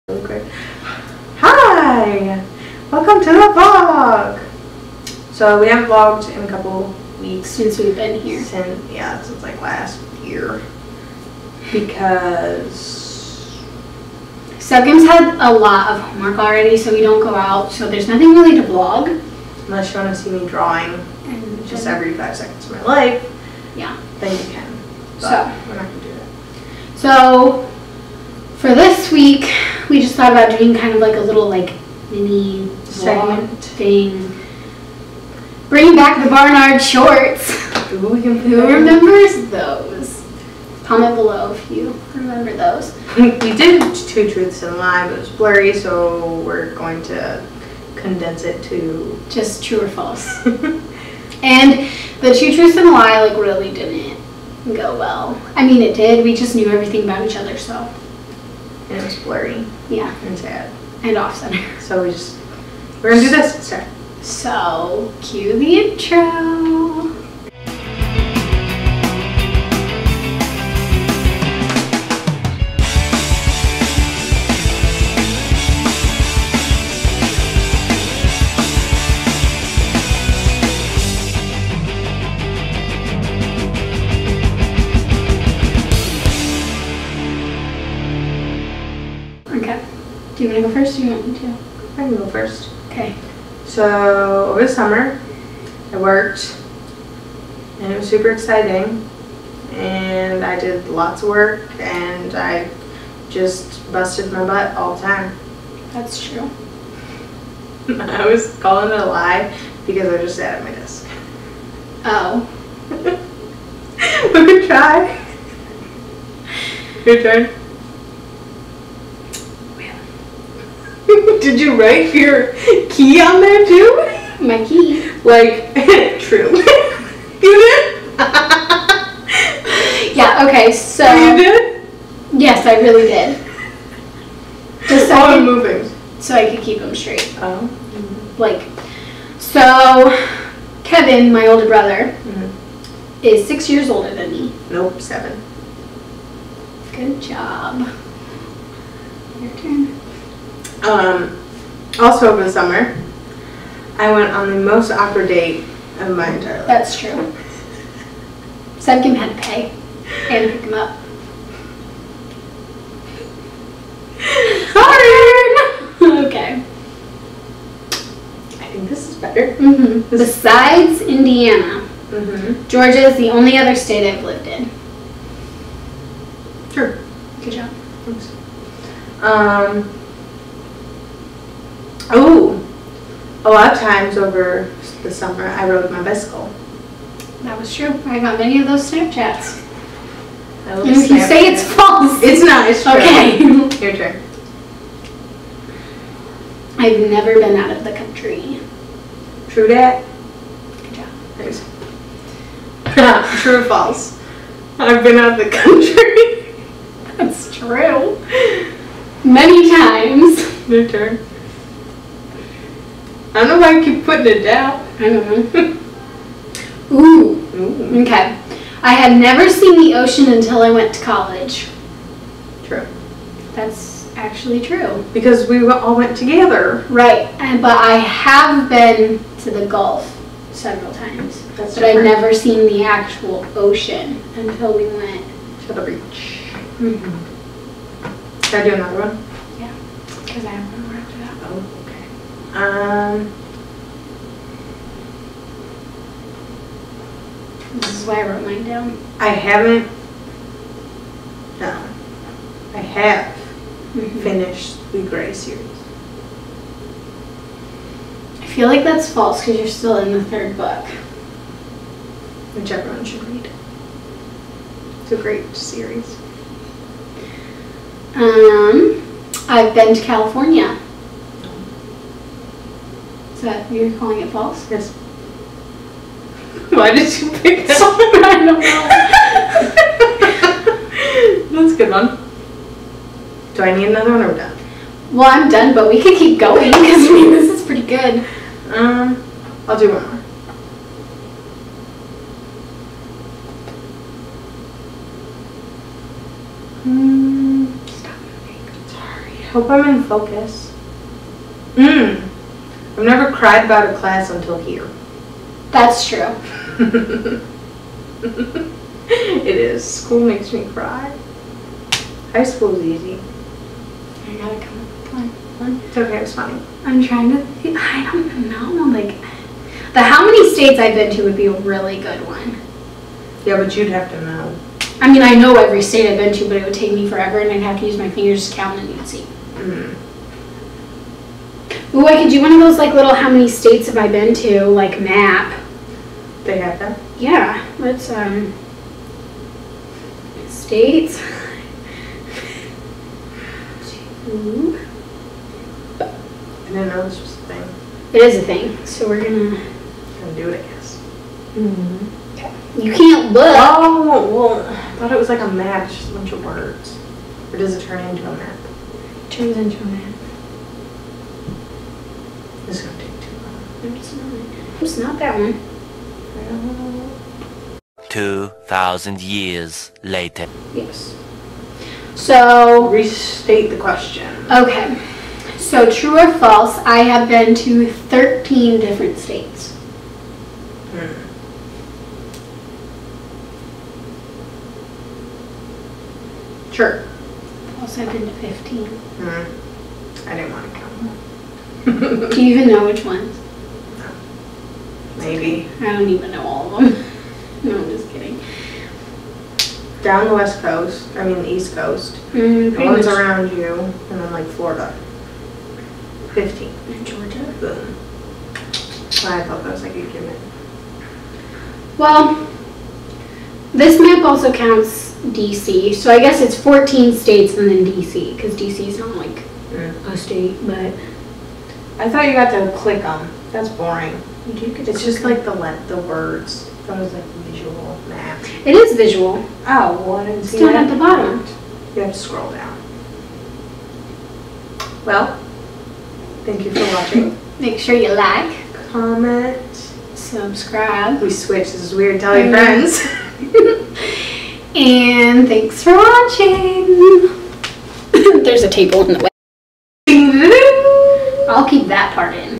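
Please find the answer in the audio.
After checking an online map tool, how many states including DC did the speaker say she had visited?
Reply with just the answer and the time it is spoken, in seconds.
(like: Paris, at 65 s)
15, at 388 s.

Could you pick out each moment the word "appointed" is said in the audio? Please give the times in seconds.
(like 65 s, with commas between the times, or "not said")
not said.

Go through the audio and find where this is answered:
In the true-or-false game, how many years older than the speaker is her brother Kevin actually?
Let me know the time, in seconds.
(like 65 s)
145 s.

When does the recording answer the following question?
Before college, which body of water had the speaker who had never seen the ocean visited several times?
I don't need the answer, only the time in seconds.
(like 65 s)
229 s.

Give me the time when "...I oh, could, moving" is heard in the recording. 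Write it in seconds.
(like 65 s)
135 s.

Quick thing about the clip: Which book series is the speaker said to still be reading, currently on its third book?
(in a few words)
Gray series.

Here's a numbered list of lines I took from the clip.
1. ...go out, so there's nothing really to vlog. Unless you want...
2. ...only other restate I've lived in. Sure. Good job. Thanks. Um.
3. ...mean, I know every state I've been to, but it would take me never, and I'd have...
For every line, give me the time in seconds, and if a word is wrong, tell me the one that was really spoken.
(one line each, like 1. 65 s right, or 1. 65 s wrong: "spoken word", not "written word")
1. 17 s right
2. 173 s wrong: "state", not "restate"
3. 325 s wrong: "forever", not "never".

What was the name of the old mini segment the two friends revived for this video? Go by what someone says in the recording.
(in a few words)
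Barnard shorts.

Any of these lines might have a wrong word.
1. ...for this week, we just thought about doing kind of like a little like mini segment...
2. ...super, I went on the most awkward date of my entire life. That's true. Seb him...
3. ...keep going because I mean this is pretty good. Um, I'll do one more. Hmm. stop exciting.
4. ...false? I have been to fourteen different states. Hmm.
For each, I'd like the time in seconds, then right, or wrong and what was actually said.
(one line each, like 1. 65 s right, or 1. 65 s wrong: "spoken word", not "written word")
1. 28 s right
2. 152 s wrong: "summer", not "super"
3. 286 s wrong: "moving", not "exciting"
4. 376 s wrong: "thirteen", not "fourteen".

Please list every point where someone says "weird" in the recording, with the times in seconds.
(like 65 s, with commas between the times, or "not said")
441 s.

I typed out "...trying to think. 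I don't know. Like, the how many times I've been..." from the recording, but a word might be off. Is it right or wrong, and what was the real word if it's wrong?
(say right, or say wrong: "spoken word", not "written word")
wrong: "states", not "times".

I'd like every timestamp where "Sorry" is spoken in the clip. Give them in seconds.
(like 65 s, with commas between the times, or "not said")
164 s, 298 s.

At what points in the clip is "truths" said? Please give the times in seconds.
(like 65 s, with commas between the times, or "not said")
44 s, 52 s.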